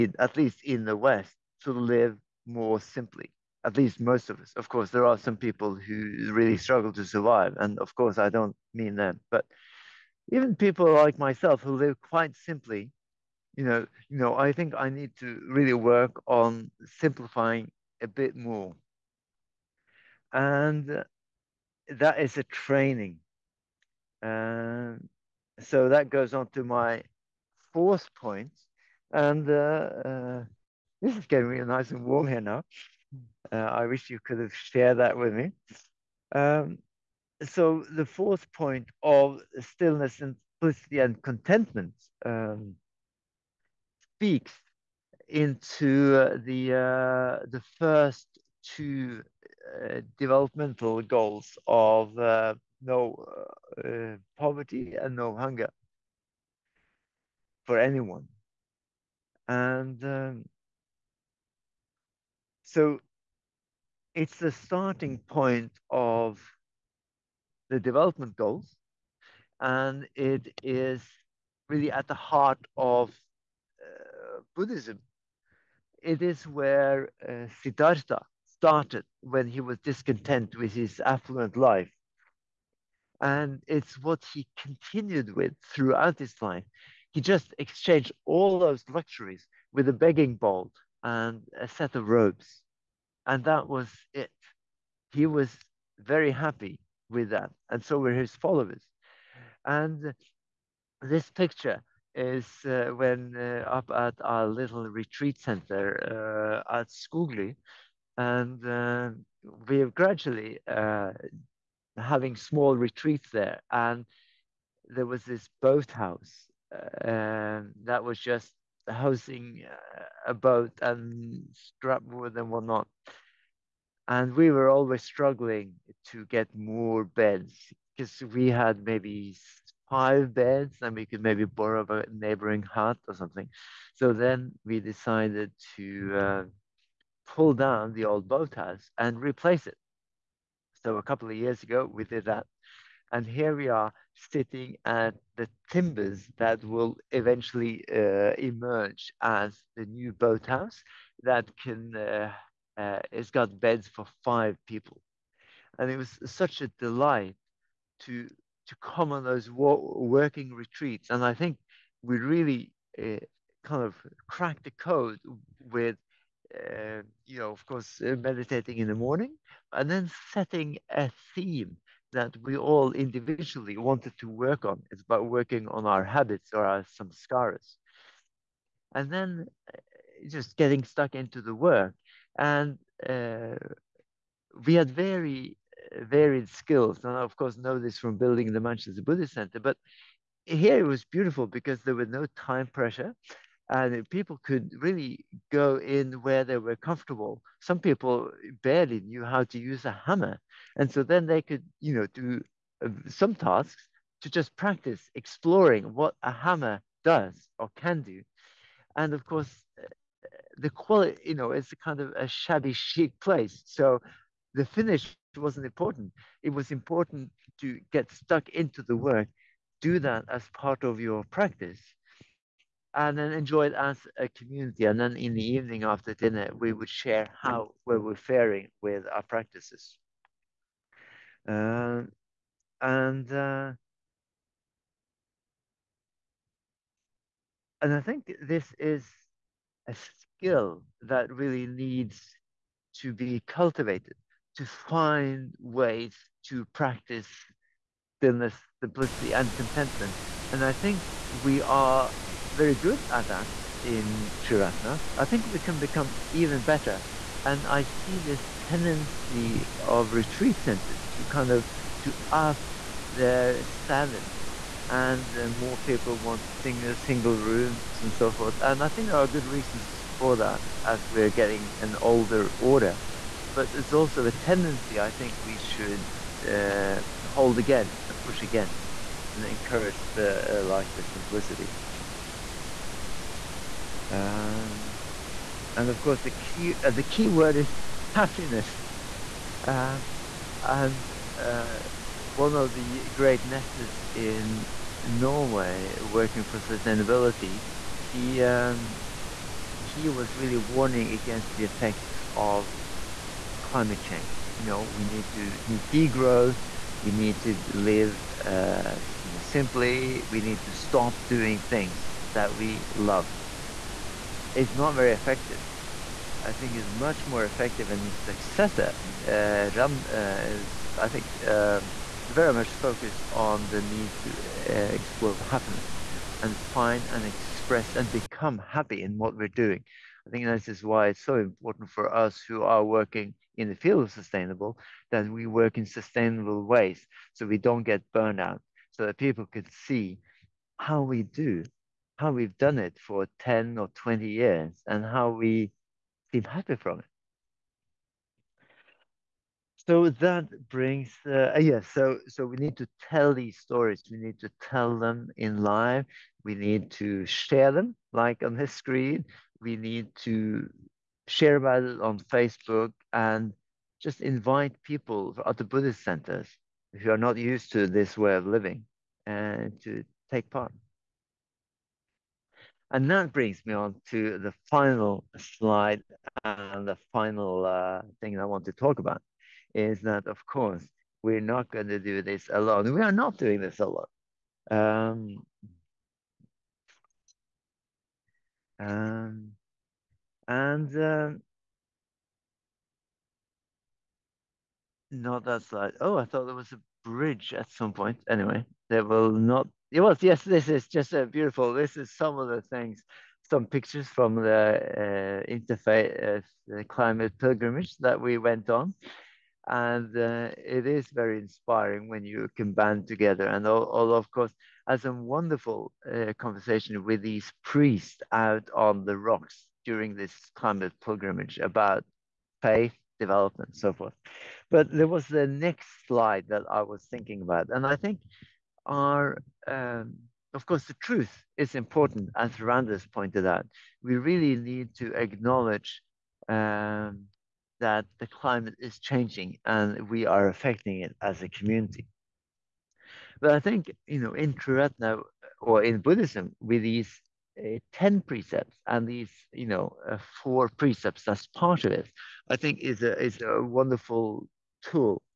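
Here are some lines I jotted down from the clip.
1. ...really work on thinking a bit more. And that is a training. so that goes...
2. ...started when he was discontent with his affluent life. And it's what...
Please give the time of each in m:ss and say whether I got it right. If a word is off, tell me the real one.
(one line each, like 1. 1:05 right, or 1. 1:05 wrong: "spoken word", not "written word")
1. 0:15 wrong: "simplifying", not "thinking"
2. 1:18 right.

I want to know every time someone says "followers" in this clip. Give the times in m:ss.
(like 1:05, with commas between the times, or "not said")
1:38.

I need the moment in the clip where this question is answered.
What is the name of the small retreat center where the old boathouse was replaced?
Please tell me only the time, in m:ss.
1:46.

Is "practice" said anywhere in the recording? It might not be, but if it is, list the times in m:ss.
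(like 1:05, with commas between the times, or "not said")
3:24, 3:41, 3:49, 4:06.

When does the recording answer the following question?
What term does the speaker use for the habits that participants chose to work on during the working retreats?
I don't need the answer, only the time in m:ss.
2:56.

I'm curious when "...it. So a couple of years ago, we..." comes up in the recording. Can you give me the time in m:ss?
2:19.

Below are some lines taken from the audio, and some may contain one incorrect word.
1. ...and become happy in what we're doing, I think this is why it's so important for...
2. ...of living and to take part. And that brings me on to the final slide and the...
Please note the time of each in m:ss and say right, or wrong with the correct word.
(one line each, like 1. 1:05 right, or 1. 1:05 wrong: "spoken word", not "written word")
1. 5:27 right
2. 6:08 right.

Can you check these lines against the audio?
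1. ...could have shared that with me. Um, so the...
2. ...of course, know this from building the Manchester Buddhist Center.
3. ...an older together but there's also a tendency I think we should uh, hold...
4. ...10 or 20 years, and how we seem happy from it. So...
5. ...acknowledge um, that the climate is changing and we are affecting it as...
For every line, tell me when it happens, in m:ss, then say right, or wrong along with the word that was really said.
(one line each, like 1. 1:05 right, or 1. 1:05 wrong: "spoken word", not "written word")
1. 0:34 right
2. 3:07 right
3. 4:31 wrong: "order", not "together"
4. 5:43 right
5. 7:15 right.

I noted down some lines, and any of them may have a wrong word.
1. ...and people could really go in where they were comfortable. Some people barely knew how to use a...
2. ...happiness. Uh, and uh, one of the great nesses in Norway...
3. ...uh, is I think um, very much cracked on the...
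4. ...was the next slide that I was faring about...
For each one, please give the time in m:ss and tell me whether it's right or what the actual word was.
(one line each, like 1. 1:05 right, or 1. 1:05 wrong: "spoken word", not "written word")
1. 3:13 right
2. 4:48 right
3. 5:20 wrong: "focused", not "cracked"
4. 7:05 wrong: "thinking", not "faring".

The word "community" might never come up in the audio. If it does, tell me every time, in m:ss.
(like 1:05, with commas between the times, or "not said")
3:44, 7:21.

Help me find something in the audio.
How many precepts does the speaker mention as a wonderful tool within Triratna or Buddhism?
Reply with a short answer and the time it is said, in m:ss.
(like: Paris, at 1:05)
10, at 7:27.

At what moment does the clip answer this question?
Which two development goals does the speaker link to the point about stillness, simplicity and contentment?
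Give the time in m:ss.
0:52.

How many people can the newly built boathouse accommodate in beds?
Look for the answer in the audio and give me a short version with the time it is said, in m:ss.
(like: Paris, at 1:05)
5, at 2:34.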